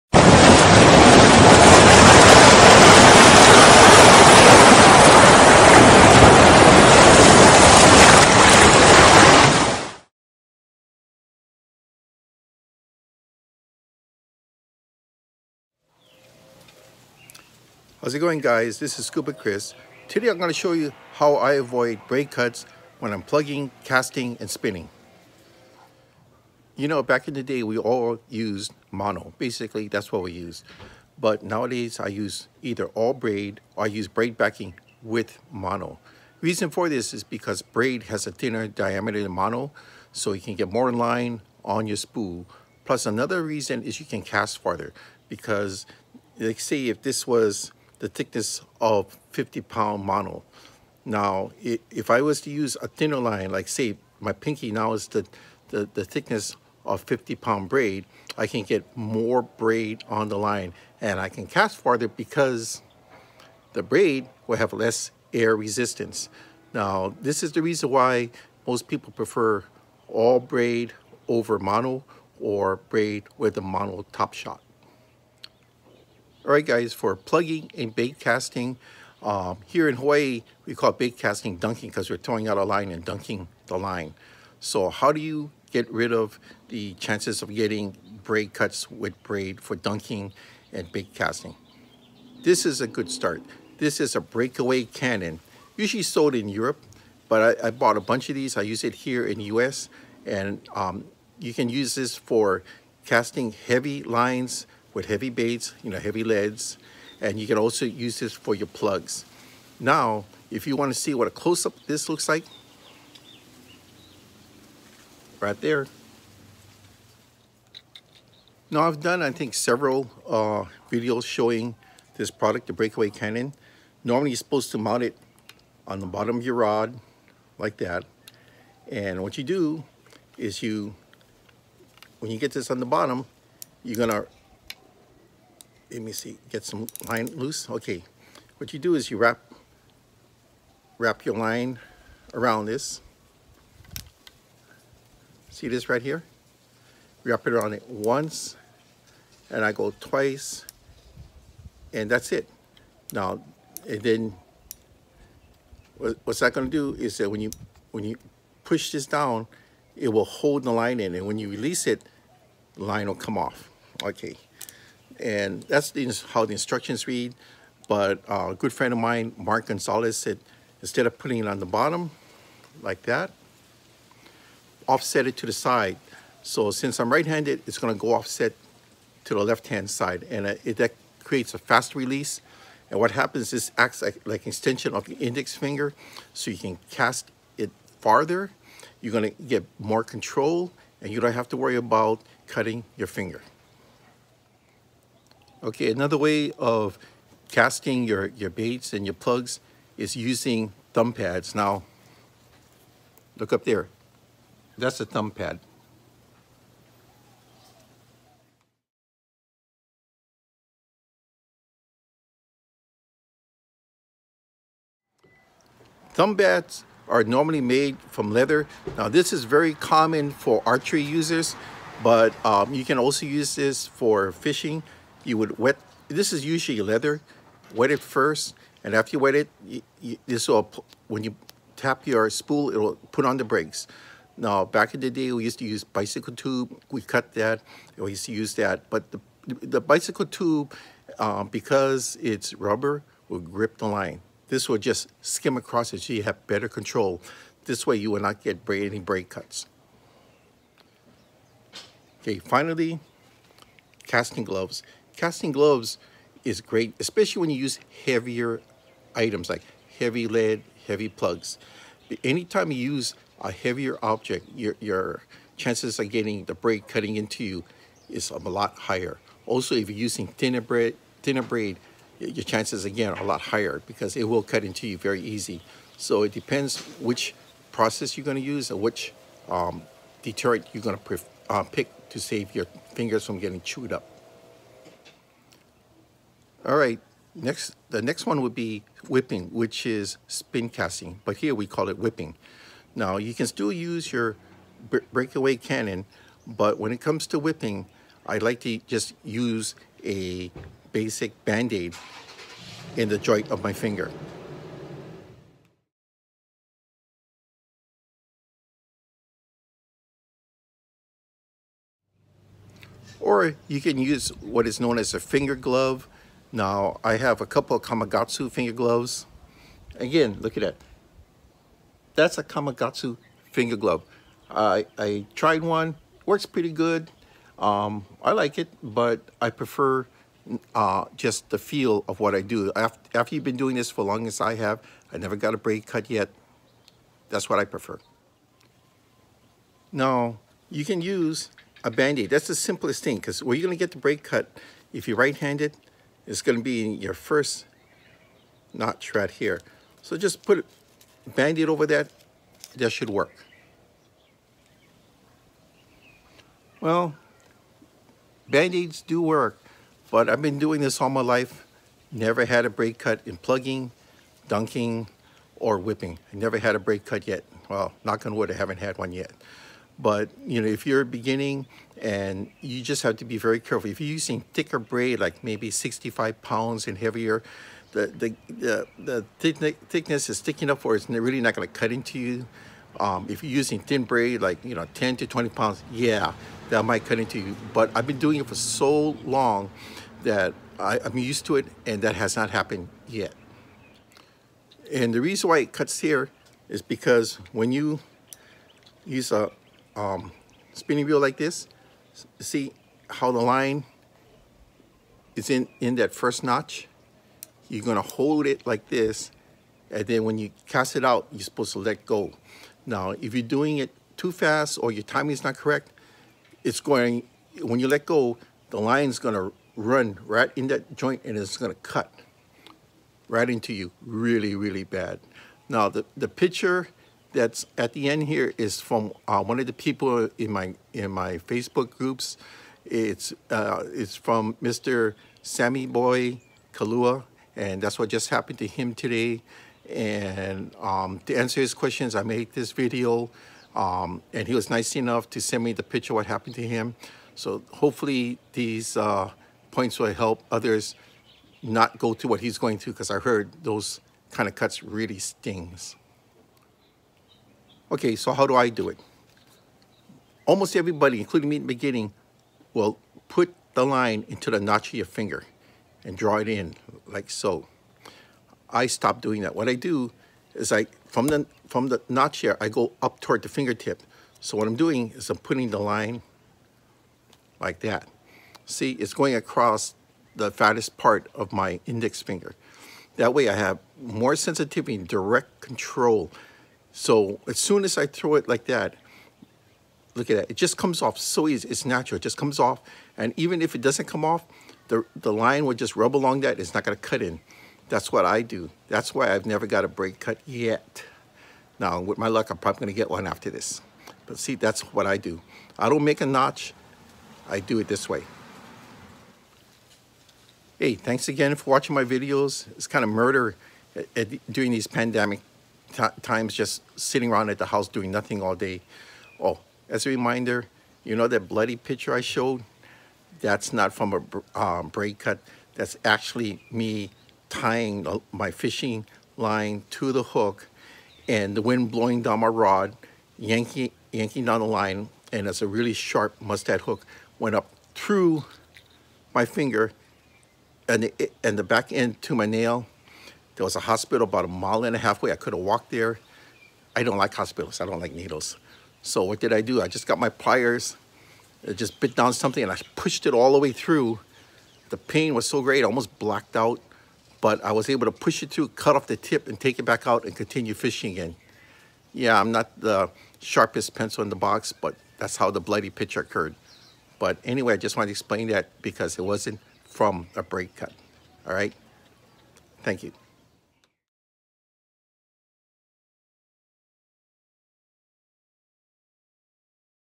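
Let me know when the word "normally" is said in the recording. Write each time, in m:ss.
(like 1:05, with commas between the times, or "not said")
2:04, 3:37.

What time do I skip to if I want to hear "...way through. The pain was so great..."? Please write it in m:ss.
9:13.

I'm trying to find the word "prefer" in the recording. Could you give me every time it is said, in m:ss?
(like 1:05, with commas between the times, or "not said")
1:09, 5:29, 5:37.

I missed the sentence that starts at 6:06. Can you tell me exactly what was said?
I never had a braid cut yet.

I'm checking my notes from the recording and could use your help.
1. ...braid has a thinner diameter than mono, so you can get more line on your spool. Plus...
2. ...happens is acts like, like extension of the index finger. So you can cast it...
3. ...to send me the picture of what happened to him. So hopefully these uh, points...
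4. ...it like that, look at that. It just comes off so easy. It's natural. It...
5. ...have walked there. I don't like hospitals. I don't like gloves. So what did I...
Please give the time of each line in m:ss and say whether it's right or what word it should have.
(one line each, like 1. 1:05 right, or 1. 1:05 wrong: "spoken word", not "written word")
1. 0:37 right
2. 3:03 right
3. 7:25 right
4. 8:08 right
5. 9:05 wrong: "needles", not "gloves".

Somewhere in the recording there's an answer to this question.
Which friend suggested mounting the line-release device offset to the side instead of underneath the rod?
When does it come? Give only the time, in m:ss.
2:49.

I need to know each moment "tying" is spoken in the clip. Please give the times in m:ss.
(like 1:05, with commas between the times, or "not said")
8:47.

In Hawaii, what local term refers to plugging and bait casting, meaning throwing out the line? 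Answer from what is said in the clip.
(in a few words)
bait casting dunking.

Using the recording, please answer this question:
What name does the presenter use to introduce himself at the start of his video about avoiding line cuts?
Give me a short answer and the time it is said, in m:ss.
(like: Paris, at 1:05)
Scuba Chris, at 0:19.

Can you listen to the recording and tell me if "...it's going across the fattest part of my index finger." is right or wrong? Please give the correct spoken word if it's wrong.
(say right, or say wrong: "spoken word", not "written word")
right.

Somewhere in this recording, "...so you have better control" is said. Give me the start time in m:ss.
4:06.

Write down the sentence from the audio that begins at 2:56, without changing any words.
So since I'm right-handed, it's gonna go offset to the left-hand side.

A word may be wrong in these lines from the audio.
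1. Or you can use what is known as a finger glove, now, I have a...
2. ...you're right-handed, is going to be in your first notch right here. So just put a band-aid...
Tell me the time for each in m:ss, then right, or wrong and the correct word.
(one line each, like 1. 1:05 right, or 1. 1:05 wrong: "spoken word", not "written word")
1. 5:13 right
2. 5:45 right.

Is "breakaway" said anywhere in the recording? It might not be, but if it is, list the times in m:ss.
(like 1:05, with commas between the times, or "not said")
1:34, 2:02, 4:55.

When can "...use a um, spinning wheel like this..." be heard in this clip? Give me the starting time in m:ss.
6:39.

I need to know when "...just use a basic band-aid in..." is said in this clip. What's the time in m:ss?
4:58.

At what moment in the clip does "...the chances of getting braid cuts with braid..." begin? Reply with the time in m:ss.
1:26.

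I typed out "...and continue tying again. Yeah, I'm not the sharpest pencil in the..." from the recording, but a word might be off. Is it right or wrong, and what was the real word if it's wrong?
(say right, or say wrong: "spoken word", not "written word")
wrong: "fishing", not "tying".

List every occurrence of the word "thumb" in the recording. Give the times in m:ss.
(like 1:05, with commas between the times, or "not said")
3:20, 3:25, 3:36.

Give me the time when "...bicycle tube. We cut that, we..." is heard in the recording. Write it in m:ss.
3:55.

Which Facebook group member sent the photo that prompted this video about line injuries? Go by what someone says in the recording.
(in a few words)
Sammy Boy Kalua.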